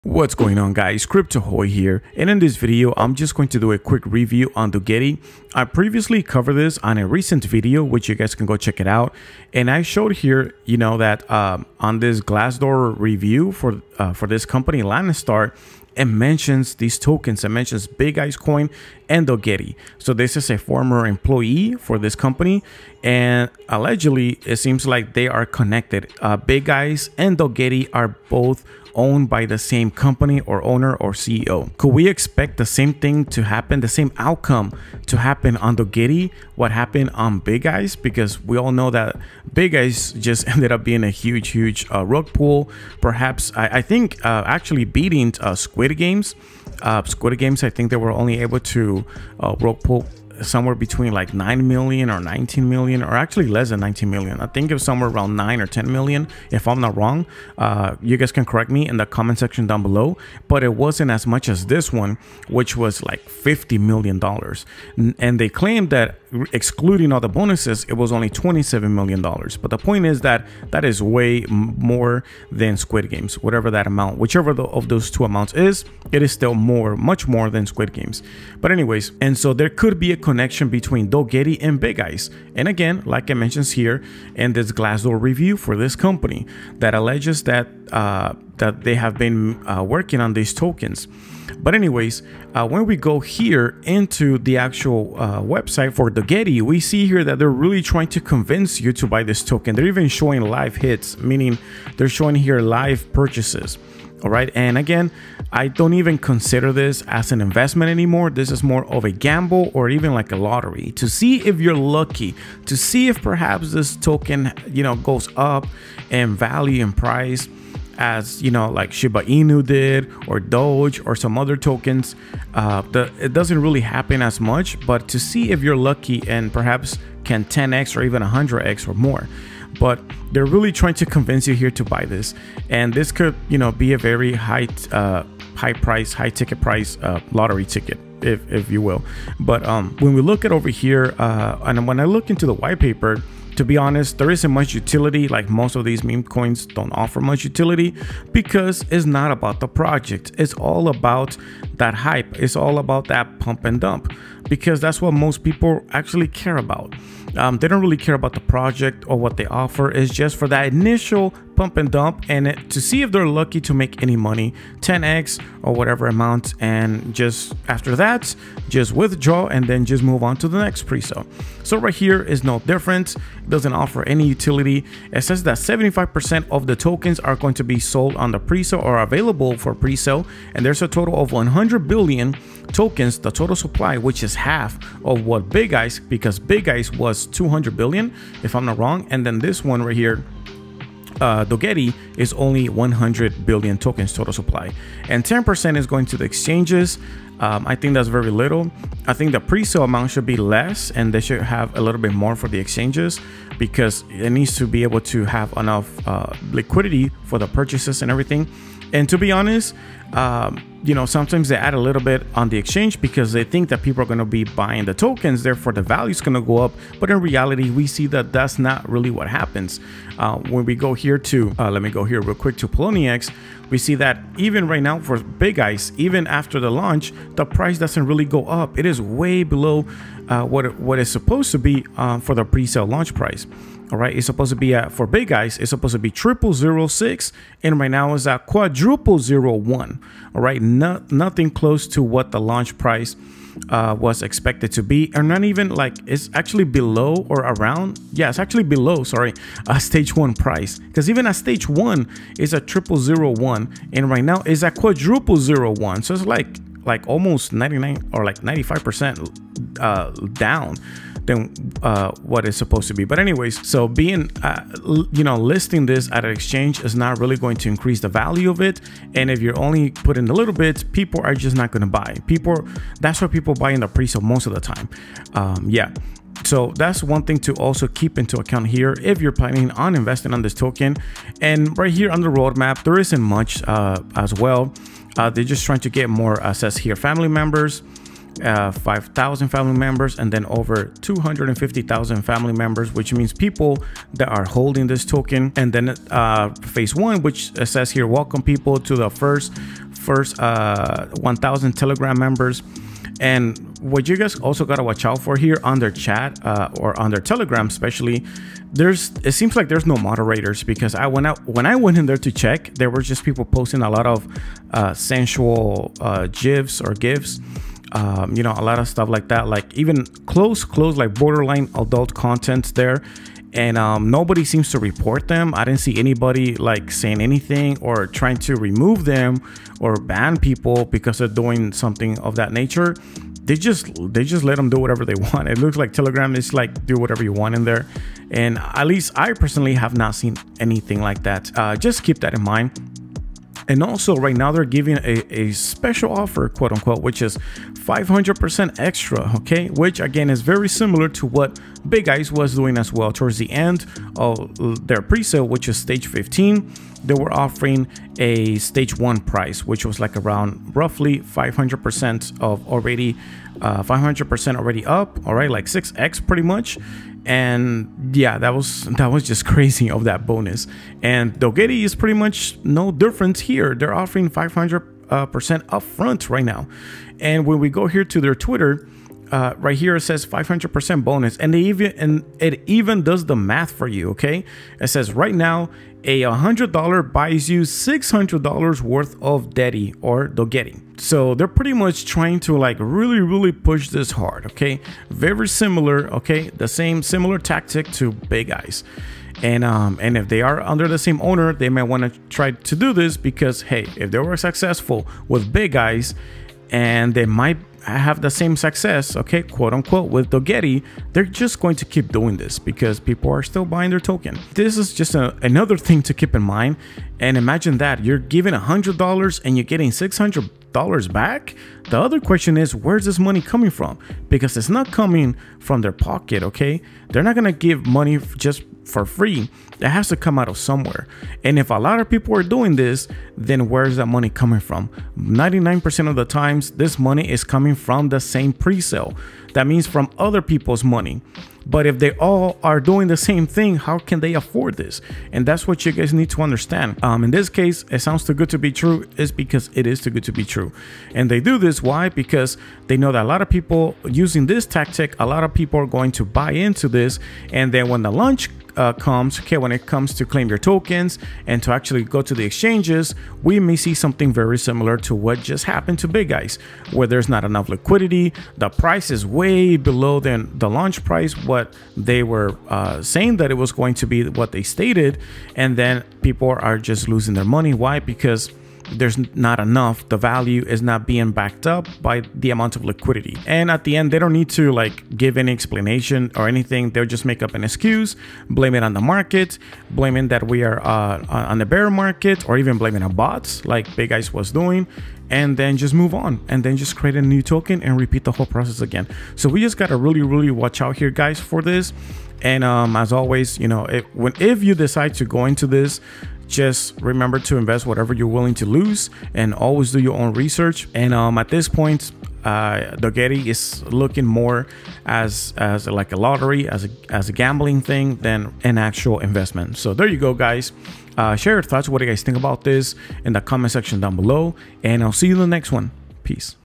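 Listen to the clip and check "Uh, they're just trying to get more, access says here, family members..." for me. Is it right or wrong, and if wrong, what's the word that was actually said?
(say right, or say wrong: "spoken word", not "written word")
right.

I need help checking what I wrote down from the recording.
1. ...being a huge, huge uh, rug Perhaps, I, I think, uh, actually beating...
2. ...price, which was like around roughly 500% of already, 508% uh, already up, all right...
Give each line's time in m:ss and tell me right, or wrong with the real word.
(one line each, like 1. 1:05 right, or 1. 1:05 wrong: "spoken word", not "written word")
1. 0:40 right
2. 5:59 wrong: "500", not "508".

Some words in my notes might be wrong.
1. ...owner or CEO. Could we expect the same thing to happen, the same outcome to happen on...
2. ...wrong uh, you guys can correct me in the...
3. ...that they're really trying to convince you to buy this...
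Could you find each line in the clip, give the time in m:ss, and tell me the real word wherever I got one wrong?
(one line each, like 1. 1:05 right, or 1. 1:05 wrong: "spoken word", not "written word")
1. 0:30 right
2. 0:56 right
3. 1:37 right.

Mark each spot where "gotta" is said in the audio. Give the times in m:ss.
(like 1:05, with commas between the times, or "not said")
5:04, 8:19.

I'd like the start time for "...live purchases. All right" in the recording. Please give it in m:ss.
1:42.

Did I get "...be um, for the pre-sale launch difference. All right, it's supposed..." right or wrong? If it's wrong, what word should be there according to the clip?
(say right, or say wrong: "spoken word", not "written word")
wrong: "price", not "difference".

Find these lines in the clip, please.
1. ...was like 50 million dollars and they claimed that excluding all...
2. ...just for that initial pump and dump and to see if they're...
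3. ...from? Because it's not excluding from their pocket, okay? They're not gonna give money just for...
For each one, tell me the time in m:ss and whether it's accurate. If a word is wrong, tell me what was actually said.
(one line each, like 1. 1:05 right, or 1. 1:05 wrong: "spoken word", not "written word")
1. 1:02 right
2. 2:40 right
3. 7:03 wrong: "coming", not "excluding".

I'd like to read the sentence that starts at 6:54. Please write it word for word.
This is just a, another thing to keep in mind.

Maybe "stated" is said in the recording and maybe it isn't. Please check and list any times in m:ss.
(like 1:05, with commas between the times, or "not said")
7:54.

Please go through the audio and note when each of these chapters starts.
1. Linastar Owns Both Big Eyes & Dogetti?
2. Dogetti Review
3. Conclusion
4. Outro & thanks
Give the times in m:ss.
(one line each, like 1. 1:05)
1. 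0:11
2. 1:33
3. 8:04
4. 8:40.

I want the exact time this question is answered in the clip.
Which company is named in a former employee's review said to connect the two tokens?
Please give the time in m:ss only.
0:14.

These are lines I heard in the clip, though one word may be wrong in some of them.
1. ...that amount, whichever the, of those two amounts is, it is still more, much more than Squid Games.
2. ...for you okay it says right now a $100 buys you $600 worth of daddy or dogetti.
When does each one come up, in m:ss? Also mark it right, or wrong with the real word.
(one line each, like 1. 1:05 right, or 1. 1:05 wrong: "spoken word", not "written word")
1. 1:13 right
2. 6:23 right.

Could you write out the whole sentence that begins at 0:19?
So this is a former employee for this company and allegedly it seems like they are connected.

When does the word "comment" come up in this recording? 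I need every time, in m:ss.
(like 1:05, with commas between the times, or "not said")
0:59, 8:43.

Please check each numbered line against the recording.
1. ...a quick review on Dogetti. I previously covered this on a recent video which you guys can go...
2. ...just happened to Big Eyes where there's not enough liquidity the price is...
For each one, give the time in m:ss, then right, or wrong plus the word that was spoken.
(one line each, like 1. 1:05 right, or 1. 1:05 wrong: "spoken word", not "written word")
1. 0:03 right
2. 7:45 right.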